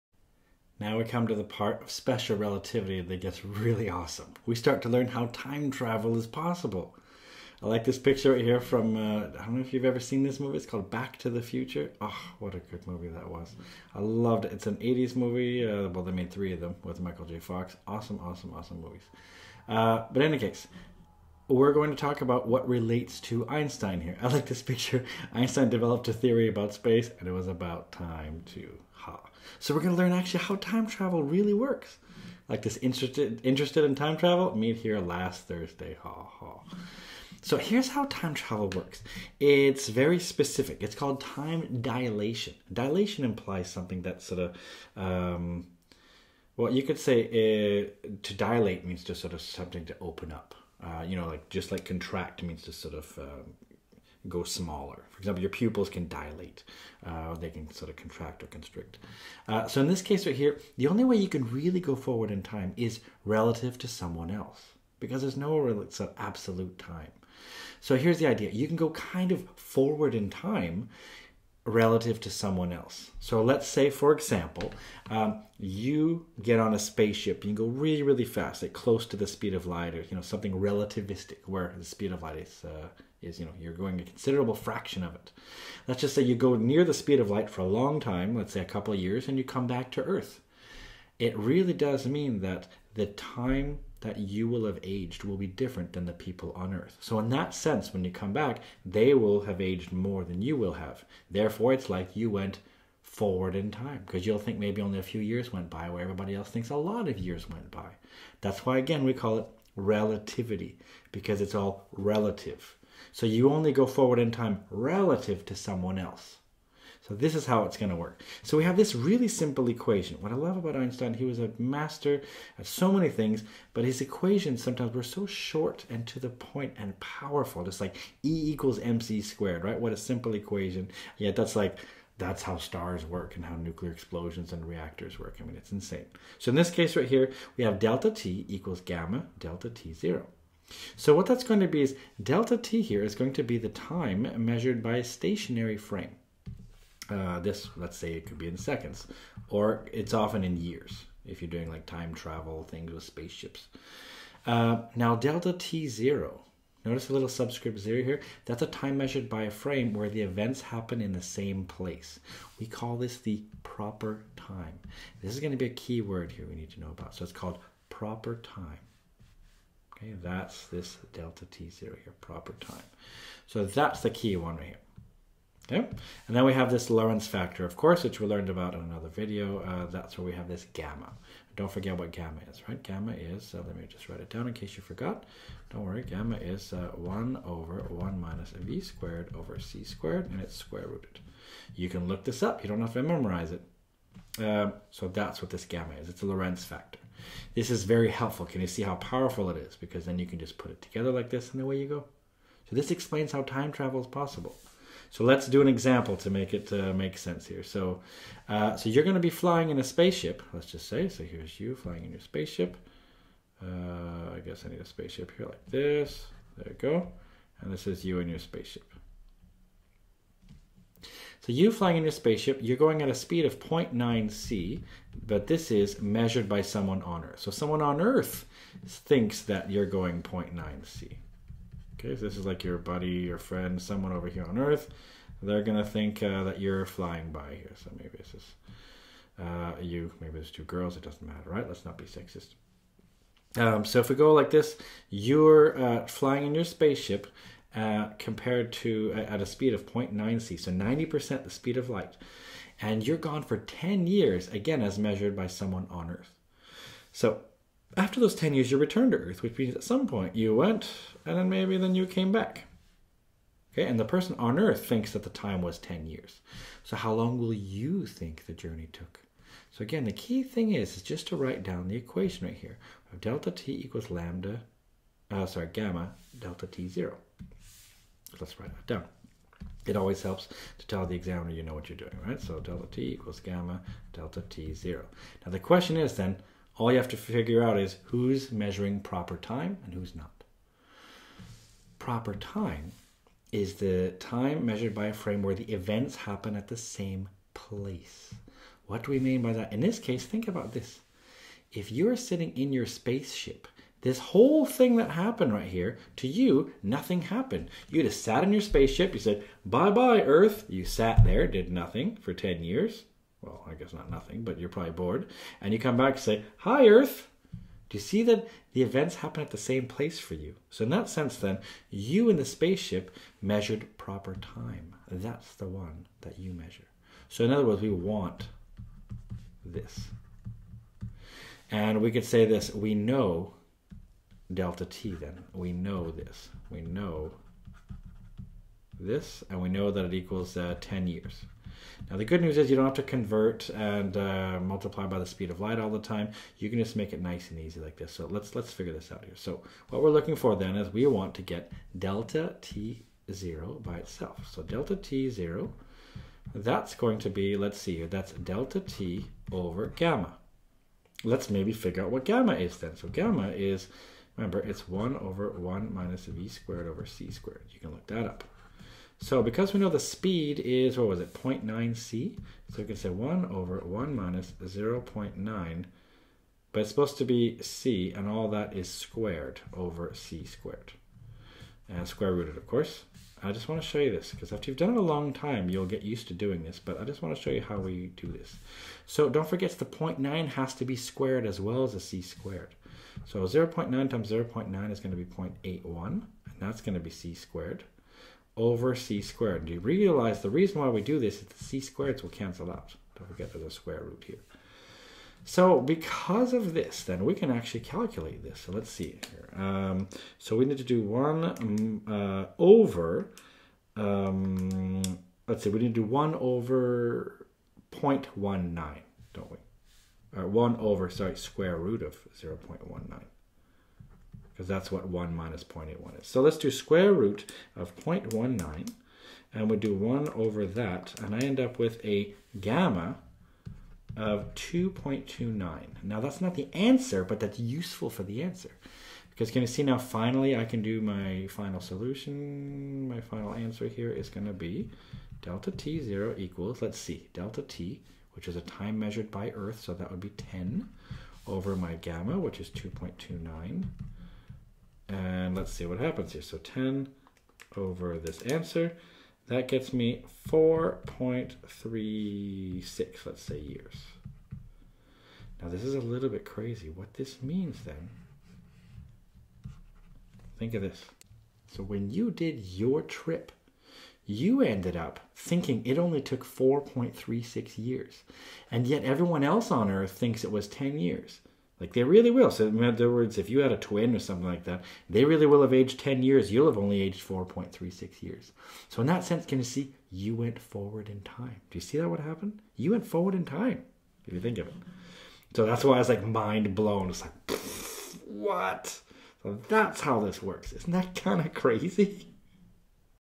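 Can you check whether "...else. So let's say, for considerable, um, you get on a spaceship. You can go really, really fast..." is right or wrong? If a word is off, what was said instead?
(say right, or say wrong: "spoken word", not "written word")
wrong: "example", not "considerable".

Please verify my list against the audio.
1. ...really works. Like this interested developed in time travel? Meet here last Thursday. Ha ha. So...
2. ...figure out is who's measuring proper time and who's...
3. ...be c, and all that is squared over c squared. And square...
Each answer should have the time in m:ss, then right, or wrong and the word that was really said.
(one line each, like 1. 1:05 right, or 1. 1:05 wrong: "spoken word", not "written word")
1. 0:31 wrong: "interested", not "developed"
2. 4:47 right
3. 6:17 right.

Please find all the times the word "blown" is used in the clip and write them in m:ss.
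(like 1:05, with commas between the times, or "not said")
8:16.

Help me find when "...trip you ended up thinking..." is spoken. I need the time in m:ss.
7:53.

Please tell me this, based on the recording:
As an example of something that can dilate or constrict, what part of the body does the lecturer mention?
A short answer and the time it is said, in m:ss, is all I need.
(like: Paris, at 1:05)
pupils, at 0:55.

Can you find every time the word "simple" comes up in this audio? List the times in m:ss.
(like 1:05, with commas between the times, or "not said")
1:59, 2:09.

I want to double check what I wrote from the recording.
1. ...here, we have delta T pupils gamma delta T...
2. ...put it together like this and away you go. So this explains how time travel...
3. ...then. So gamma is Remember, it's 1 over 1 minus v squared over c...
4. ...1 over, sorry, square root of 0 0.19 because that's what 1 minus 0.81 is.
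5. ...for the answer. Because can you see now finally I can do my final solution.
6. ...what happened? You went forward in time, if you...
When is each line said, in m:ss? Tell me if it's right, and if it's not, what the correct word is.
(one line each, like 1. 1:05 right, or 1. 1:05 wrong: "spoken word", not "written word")
1. 2:17 wrong: "equals", not "pupils"
2. 3:20 right
3. 6:02 right
4. 7:00 right
5. 7:18 right
6. 8:12 right.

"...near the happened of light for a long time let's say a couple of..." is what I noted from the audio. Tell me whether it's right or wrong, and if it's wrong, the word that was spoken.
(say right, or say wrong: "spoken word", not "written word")
wrong: "speed", not "happened".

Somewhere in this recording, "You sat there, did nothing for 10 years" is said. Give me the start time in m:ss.
5:10.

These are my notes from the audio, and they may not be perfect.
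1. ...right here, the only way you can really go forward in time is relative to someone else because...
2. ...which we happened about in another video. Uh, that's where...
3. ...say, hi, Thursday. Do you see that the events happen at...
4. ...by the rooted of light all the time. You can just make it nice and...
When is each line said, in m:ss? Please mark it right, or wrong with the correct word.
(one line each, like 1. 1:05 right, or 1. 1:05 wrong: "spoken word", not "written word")
1. 1:00 right
2. 2:58 wrong: "learned", not "happened"
3. 5:16 wrong: "Earth", not "Thursday"
4. 5:45 wrong: "speed", not "rooted".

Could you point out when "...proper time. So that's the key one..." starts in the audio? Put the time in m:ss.
2:52.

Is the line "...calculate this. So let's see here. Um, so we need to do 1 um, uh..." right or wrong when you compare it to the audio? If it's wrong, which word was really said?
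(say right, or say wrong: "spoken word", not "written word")
right.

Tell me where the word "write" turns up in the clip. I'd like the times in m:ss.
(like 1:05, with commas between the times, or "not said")
3:04, 4:31, 4:38.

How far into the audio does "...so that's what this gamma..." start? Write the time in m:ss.
3:14.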